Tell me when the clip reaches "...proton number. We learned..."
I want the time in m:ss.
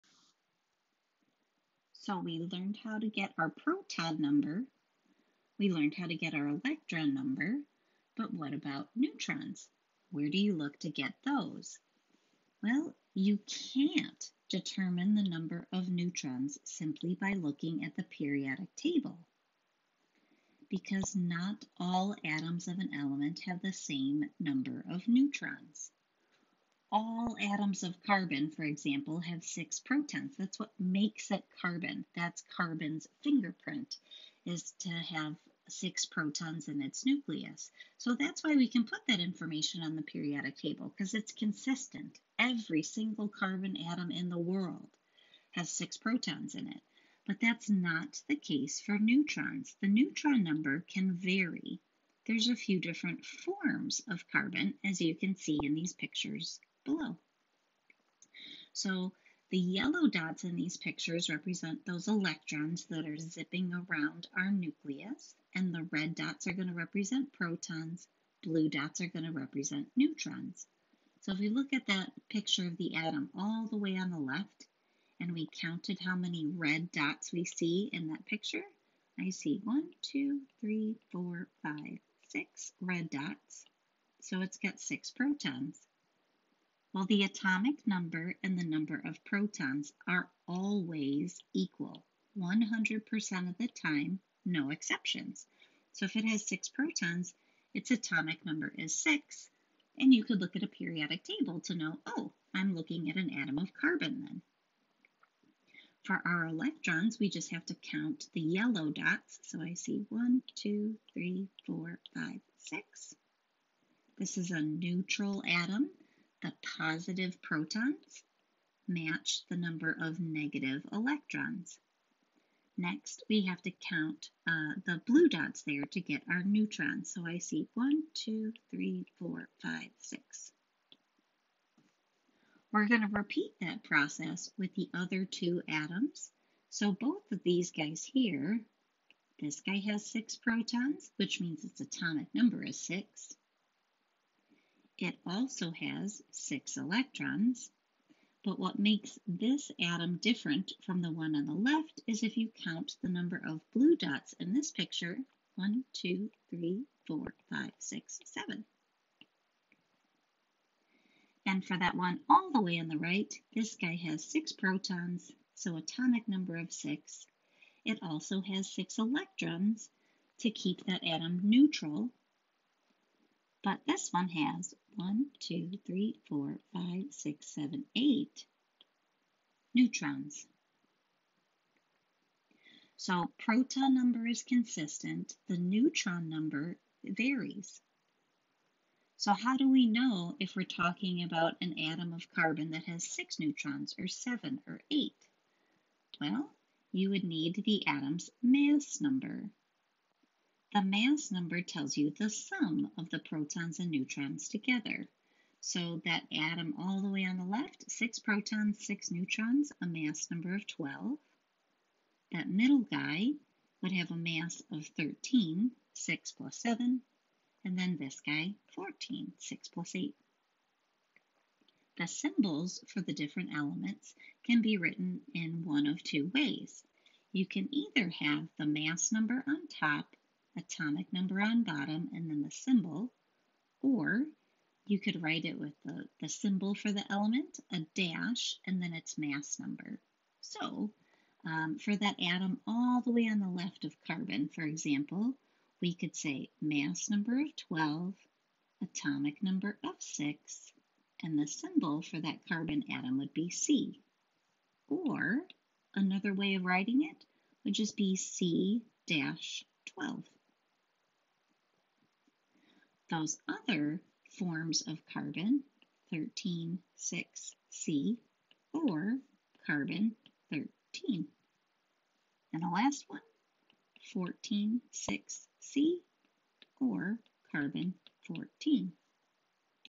0:03.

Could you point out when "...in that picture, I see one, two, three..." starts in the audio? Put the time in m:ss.
1:17.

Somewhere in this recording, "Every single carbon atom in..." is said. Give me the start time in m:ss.
0:42.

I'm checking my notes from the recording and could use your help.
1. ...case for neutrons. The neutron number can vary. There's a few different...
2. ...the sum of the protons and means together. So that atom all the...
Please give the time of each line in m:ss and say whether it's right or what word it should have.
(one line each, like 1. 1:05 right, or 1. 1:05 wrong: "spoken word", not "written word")
1. 0:48 right
2. 3:22 wrong: "neutrons", not "means".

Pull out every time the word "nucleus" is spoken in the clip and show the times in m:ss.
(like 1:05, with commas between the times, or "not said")
0:37, 1:04.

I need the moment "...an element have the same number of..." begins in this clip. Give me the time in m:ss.
0:22.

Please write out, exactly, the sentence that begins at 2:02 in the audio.
Next, we have to count uh, the blue dots there to get our neutrons.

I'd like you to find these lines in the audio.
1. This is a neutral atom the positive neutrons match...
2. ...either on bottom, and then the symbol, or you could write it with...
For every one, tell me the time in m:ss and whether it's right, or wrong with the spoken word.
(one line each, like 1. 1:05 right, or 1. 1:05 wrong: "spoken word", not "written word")
1. 1:54 wrong: "protons", not "neutrons"
2. 3:51 wrong: "number", not "either".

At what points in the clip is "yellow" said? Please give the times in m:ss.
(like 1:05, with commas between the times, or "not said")
0:59, 1:48.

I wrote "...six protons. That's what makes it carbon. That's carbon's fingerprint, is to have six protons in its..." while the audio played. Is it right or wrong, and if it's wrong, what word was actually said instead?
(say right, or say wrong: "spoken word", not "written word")
right.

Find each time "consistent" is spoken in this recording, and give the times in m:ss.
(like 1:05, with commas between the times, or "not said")
0:41, 3:04.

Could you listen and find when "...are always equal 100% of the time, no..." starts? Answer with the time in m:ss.
1:30.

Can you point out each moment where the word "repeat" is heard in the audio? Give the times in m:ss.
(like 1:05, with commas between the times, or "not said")
2:13.